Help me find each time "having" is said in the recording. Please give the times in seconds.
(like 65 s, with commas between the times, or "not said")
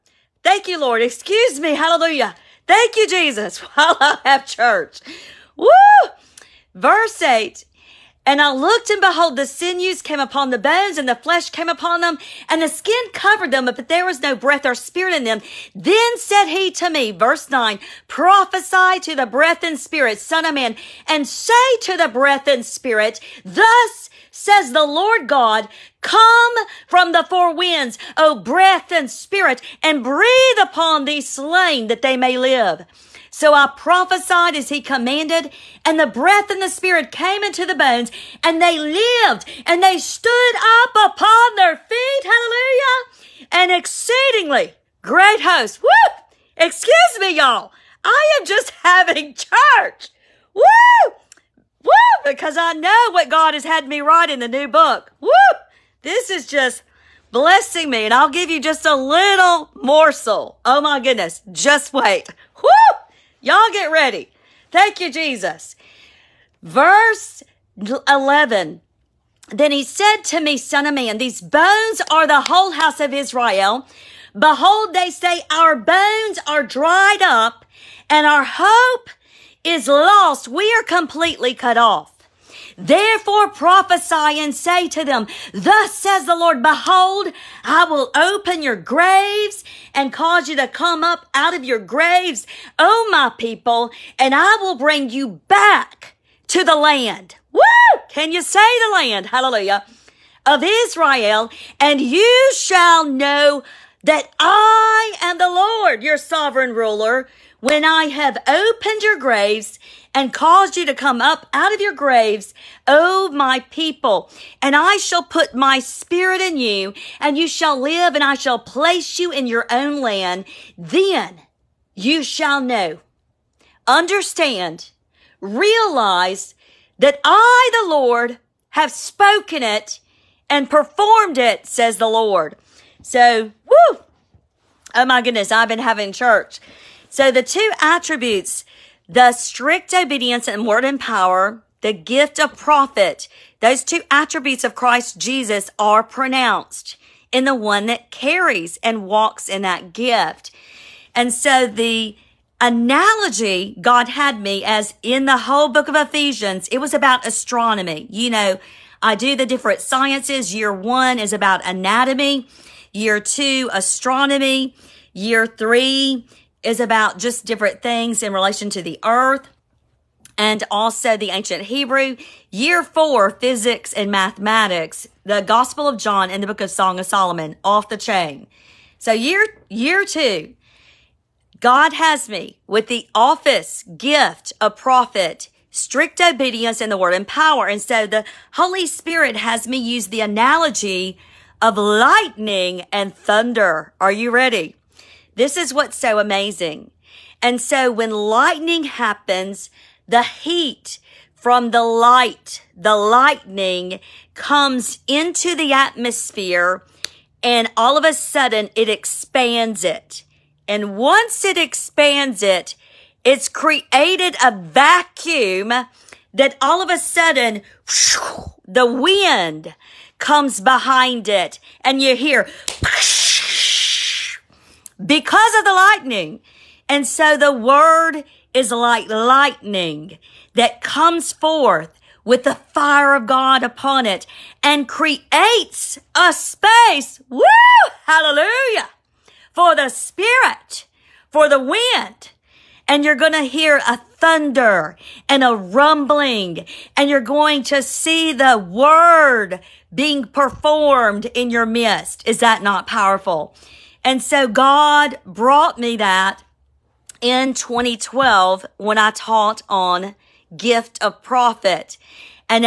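48 s, 135 s.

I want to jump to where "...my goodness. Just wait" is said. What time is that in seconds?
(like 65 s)
60 s.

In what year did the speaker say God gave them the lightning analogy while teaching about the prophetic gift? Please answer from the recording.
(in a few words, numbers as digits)
2012.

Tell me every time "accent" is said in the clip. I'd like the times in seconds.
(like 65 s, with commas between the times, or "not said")
not said.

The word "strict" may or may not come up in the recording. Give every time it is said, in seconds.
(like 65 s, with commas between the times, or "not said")
139 s, 185 s.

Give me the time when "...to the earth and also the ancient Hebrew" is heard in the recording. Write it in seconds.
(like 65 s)
168 s.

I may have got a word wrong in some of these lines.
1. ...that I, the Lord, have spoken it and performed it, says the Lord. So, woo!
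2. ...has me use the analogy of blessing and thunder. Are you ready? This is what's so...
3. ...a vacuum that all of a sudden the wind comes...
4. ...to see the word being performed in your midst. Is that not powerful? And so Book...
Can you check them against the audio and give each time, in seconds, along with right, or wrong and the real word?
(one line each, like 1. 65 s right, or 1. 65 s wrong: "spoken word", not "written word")
1. 126 s right
2. 189 s wrong: "lightning", not "blessing"
3. 214 s right
4. 247 s wrong: "God", not "Book".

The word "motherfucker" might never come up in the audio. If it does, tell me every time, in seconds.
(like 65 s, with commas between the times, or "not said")
not said.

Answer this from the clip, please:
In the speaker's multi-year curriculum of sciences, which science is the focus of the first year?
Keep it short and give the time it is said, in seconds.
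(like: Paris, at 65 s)
Anatomy, at 160 s.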